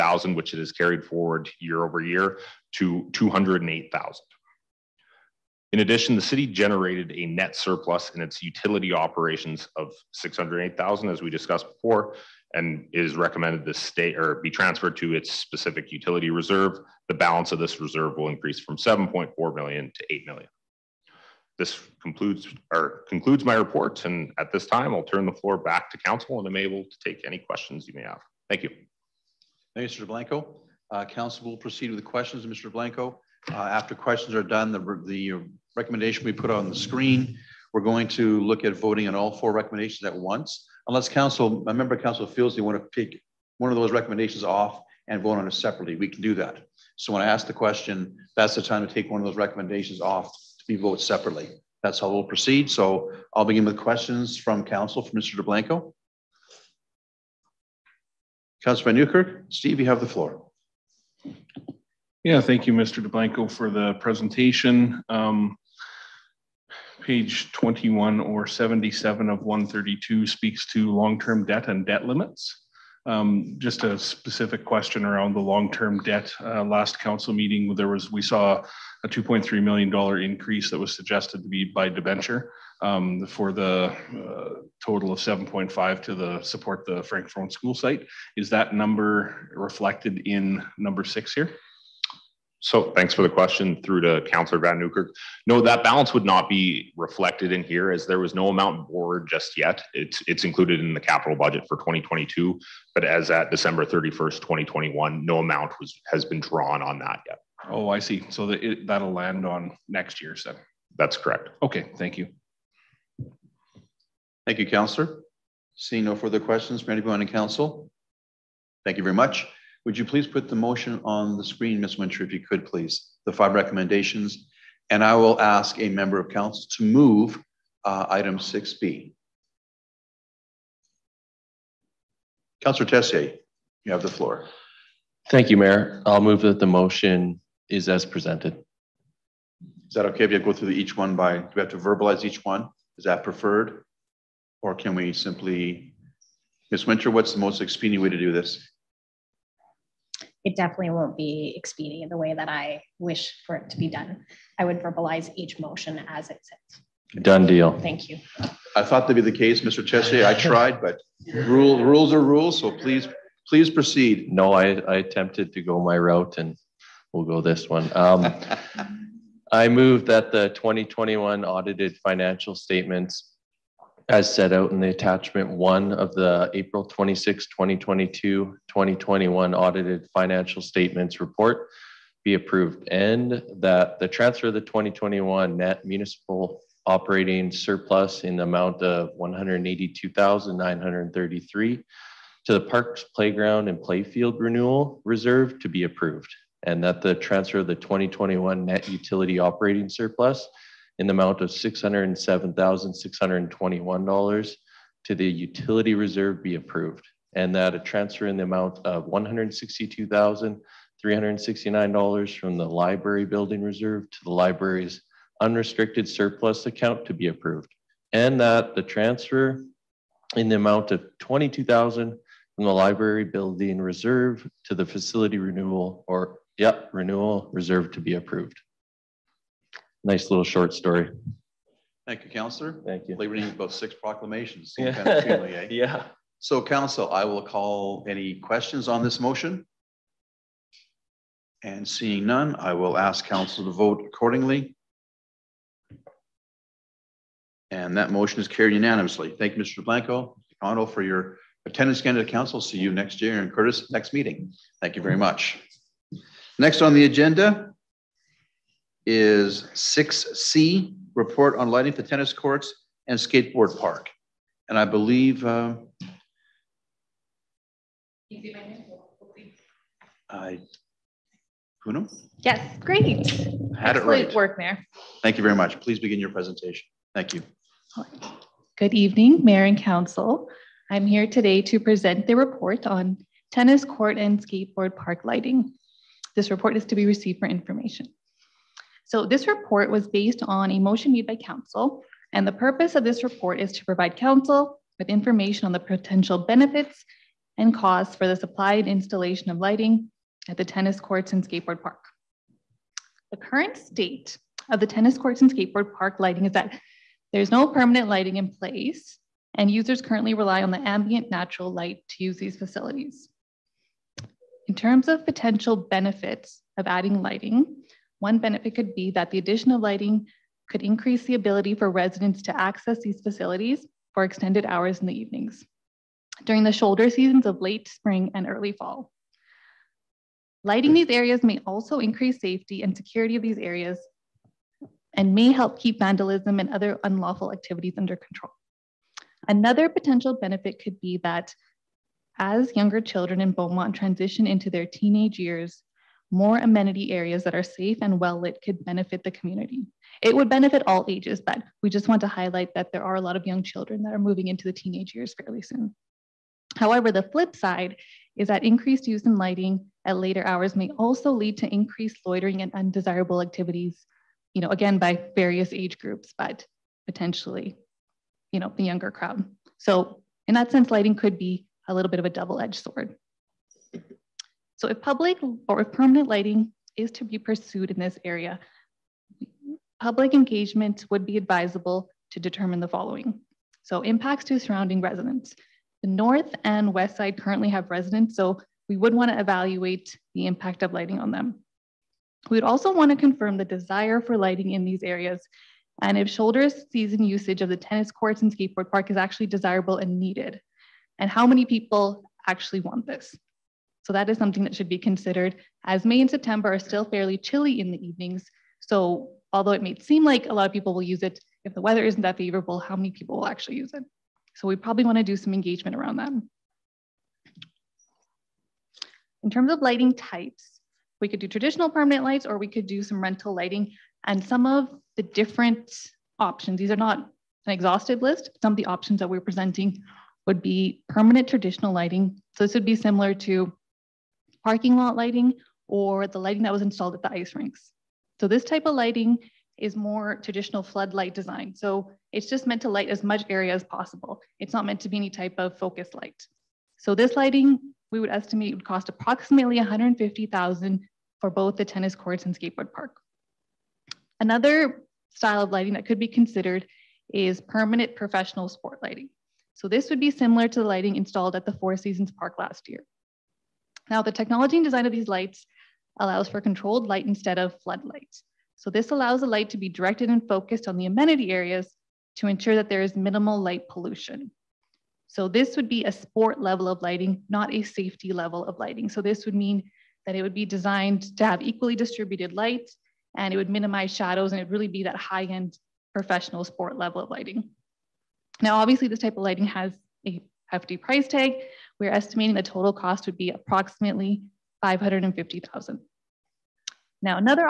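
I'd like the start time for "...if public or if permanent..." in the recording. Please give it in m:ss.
6:14.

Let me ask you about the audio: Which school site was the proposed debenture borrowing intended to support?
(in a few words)
Frankfort.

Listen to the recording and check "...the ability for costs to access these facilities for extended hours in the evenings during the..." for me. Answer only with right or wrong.
wrong.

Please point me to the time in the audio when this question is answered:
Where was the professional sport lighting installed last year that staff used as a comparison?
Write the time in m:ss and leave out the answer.
7:41.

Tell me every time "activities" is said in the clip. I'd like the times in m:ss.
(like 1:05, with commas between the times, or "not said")
5:37, 6:03.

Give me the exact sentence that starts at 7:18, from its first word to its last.
So this type of lighting is more traditional floodlight design.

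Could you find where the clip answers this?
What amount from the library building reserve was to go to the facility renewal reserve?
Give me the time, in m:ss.
3:41.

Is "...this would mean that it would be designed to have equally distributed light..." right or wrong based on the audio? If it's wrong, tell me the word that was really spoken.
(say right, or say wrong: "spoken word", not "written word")
right.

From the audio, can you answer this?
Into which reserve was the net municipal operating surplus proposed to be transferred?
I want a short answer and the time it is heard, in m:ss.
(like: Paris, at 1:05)
Parks Playground and Playfield Renewal Reserve, at 3:12.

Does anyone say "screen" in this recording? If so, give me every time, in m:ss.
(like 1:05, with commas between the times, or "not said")
0:36, 2:01.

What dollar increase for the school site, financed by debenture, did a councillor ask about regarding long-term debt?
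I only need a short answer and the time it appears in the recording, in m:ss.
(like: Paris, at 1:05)
2.3 million dollars, at 1:19.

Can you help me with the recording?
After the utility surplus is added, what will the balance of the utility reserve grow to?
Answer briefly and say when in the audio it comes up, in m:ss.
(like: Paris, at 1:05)
8 million, at 0:20.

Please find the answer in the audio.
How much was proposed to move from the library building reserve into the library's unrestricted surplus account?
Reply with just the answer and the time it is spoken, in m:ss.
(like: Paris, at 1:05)
$162,369, at 3:29.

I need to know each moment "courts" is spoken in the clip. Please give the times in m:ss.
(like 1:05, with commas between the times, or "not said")
4:22, 4:43, 5:00, 5:05, 6:38, 7:32.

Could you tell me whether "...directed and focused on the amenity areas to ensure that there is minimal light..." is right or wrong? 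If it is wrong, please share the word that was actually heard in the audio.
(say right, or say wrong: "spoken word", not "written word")
right.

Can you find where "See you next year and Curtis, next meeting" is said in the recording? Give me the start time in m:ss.
4:12.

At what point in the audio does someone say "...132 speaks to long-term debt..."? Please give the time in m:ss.
1:09.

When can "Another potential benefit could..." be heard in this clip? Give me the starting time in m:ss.
5:39.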